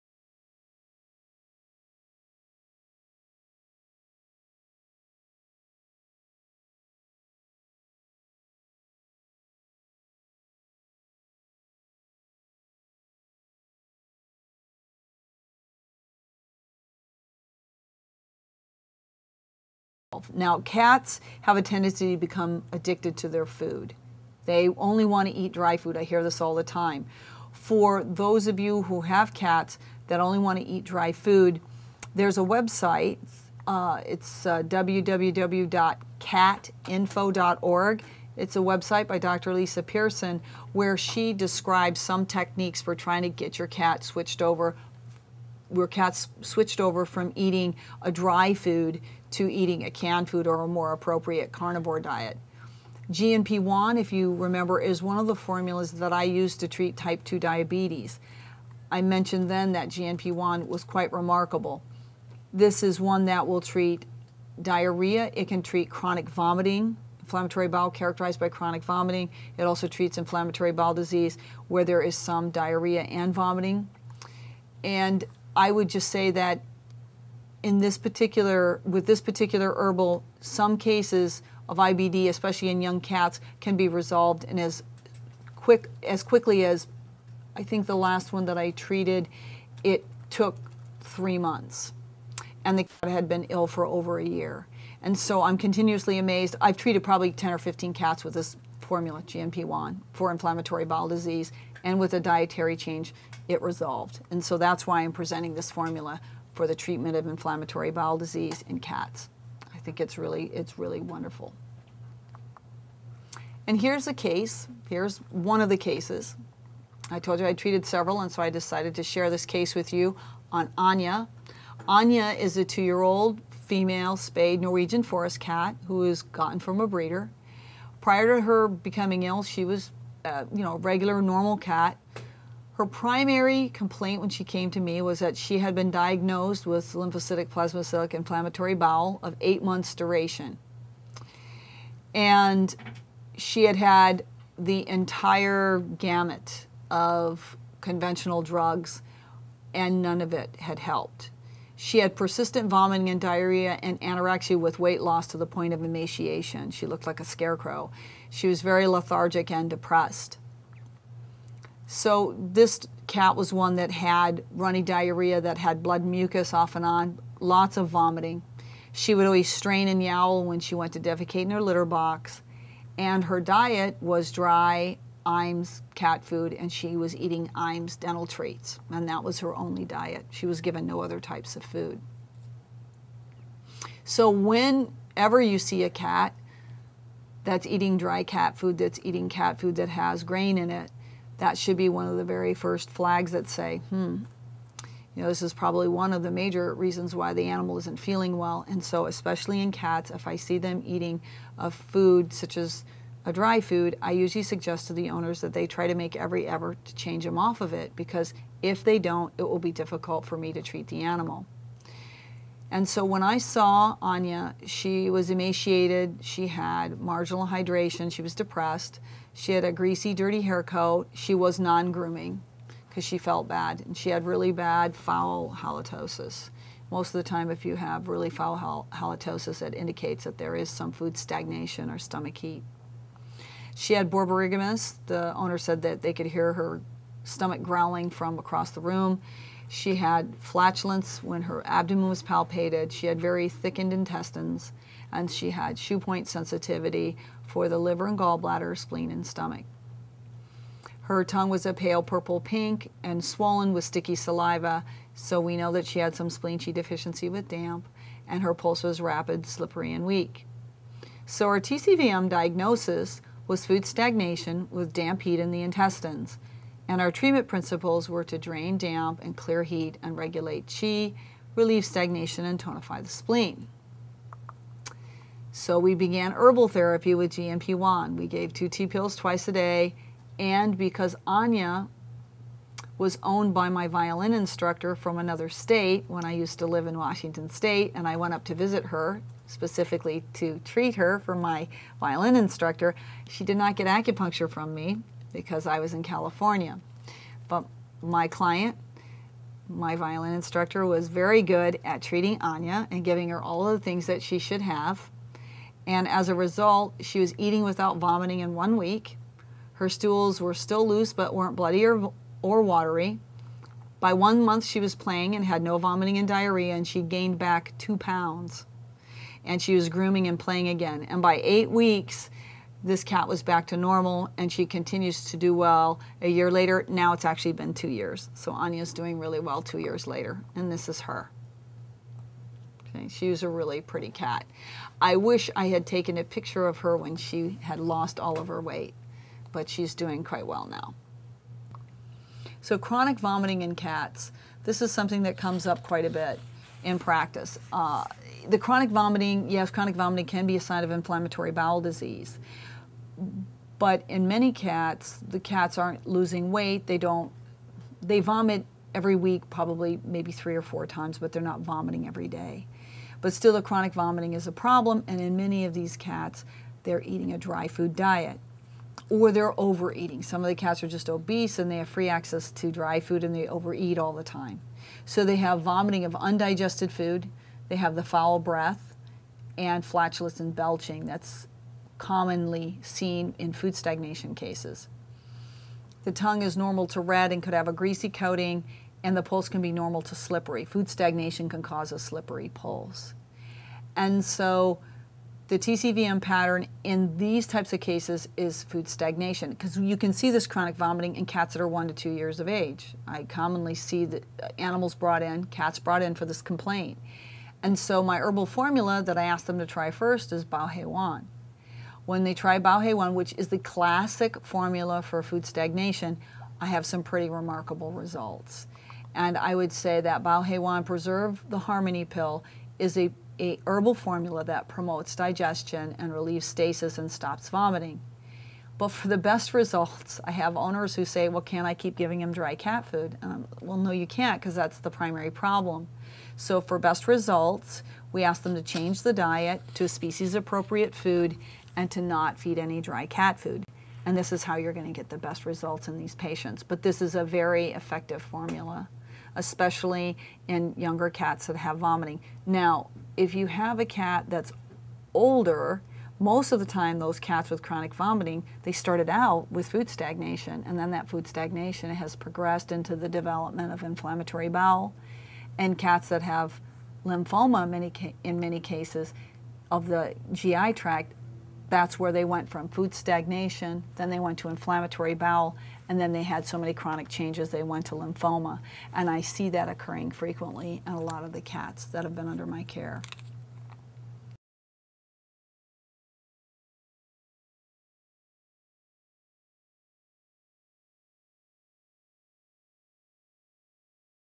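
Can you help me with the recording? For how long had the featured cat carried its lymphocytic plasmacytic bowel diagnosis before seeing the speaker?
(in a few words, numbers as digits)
8 months.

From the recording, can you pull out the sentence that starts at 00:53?
GNP1, if you remember, is one of the formulas that I use to treat type 2 diabetes.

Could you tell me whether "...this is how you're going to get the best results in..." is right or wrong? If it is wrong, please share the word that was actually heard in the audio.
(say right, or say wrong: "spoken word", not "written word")
right.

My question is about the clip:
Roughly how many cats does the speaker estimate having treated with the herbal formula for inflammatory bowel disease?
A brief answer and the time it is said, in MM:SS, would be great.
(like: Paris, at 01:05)
10 or 15, at 01:37.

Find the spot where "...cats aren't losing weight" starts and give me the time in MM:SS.
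05:55.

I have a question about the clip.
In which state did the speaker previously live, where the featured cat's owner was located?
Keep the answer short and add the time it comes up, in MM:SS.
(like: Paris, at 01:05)
Washington State, at 04:46.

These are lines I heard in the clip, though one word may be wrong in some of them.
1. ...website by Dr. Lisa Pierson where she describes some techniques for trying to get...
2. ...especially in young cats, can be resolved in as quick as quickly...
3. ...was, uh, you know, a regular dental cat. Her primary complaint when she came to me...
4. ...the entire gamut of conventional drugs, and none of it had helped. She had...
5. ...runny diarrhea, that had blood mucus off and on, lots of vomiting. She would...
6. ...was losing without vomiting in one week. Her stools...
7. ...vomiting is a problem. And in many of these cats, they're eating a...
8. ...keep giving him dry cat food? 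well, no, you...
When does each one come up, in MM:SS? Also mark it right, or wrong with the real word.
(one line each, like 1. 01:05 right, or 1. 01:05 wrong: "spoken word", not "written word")
1. 00:38 right
2. 01:22 right
3. 02:09 wrong: "normal", not "dental"
4. 02:24 right
5. 02:44 right
6. 05:07 wrong: "eating", not "losing"
7. 06:03 right
8. 07:11 right.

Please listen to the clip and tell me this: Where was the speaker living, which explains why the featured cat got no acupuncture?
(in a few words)
California.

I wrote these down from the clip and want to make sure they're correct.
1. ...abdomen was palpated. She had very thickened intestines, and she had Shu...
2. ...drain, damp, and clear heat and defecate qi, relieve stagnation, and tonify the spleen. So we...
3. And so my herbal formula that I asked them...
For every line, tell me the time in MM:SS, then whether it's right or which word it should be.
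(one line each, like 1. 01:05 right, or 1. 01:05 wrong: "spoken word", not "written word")
1. 04:01 right
2. 04:28 wrong: "regulate", not "defecate"
3. 06:47 right.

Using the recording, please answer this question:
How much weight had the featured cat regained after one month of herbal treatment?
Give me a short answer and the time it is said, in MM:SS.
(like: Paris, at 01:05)
2 pounds, at 05:17.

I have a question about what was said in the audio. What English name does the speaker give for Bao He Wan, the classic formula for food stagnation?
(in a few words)
Preserve the Harmony Pill.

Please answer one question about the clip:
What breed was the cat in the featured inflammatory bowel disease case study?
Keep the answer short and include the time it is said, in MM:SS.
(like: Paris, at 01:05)
Norwegian forest cat, at 02:04.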